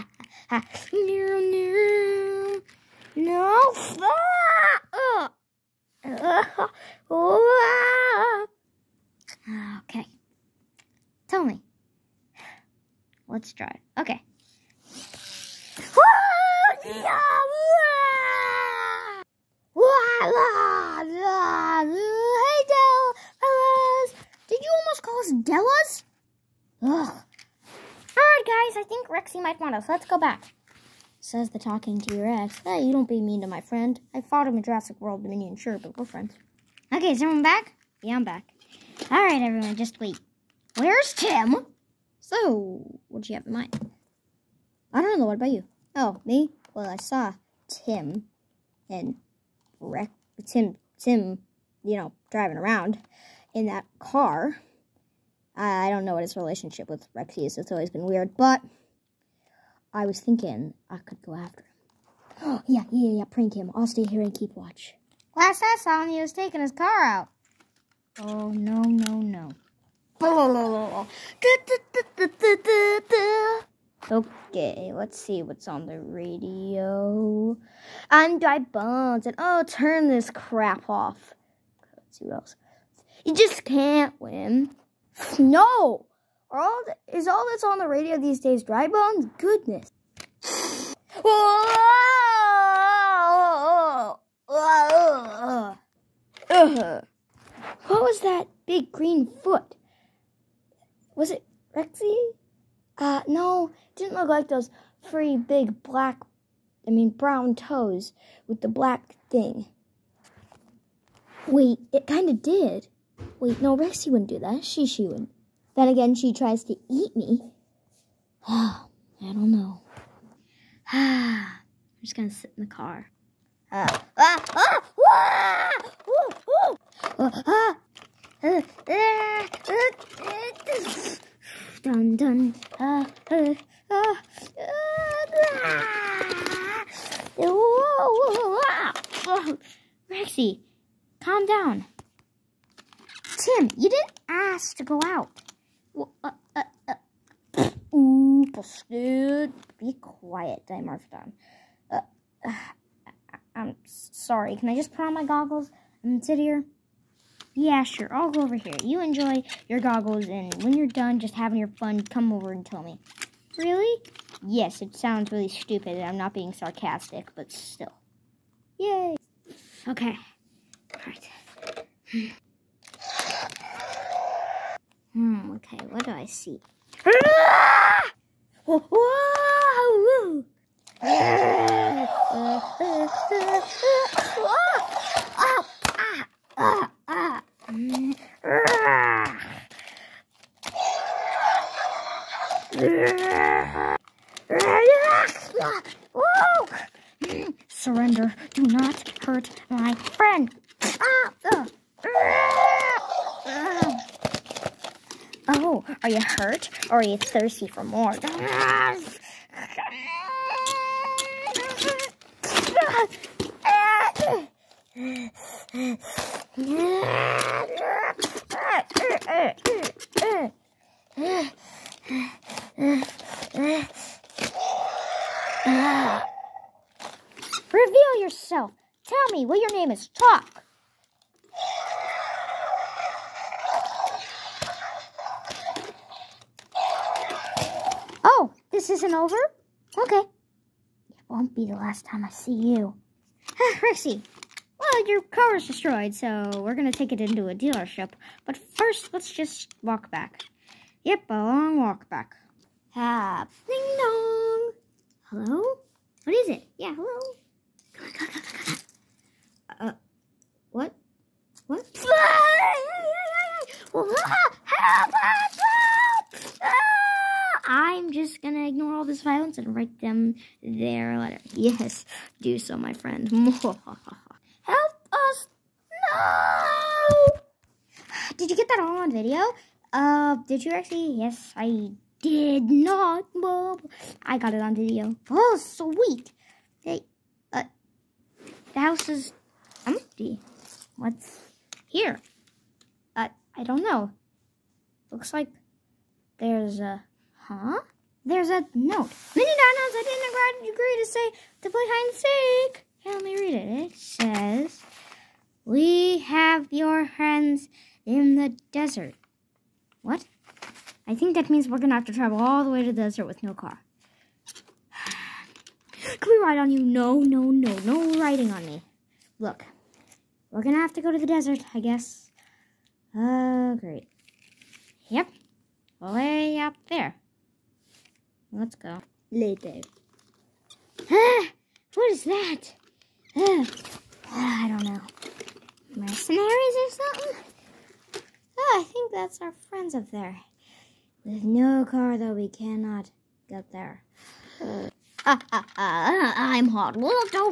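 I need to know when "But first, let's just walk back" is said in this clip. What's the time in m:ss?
4:08.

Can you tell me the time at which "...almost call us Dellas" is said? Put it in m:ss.
0:24.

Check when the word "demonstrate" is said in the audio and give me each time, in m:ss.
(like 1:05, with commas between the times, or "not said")
not said.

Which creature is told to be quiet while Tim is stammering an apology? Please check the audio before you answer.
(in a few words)
Dimorphodon.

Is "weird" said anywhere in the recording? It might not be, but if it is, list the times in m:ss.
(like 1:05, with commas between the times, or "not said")
0:58.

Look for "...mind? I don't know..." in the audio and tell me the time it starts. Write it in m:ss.
0:43.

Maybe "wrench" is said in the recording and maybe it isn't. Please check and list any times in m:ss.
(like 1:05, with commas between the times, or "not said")
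not said.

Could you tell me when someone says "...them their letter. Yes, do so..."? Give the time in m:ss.
4:29.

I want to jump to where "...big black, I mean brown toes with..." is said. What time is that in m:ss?
1:45.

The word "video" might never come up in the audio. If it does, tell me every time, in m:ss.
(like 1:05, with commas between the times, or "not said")
4:39, 4:44.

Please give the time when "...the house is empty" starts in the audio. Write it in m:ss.
4:48.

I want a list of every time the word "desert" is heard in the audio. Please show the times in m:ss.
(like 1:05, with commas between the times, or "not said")
5:08, 5:13, 5:21.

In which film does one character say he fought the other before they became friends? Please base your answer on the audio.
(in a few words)
Jurassic World Dominion.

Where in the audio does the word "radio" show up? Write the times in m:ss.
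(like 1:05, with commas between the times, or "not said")
1:15, 1:27.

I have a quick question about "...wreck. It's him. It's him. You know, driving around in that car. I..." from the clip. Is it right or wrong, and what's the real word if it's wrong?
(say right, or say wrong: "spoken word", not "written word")
right.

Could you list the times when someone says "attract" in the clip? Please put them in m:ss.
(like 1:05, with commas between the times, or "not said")
not said.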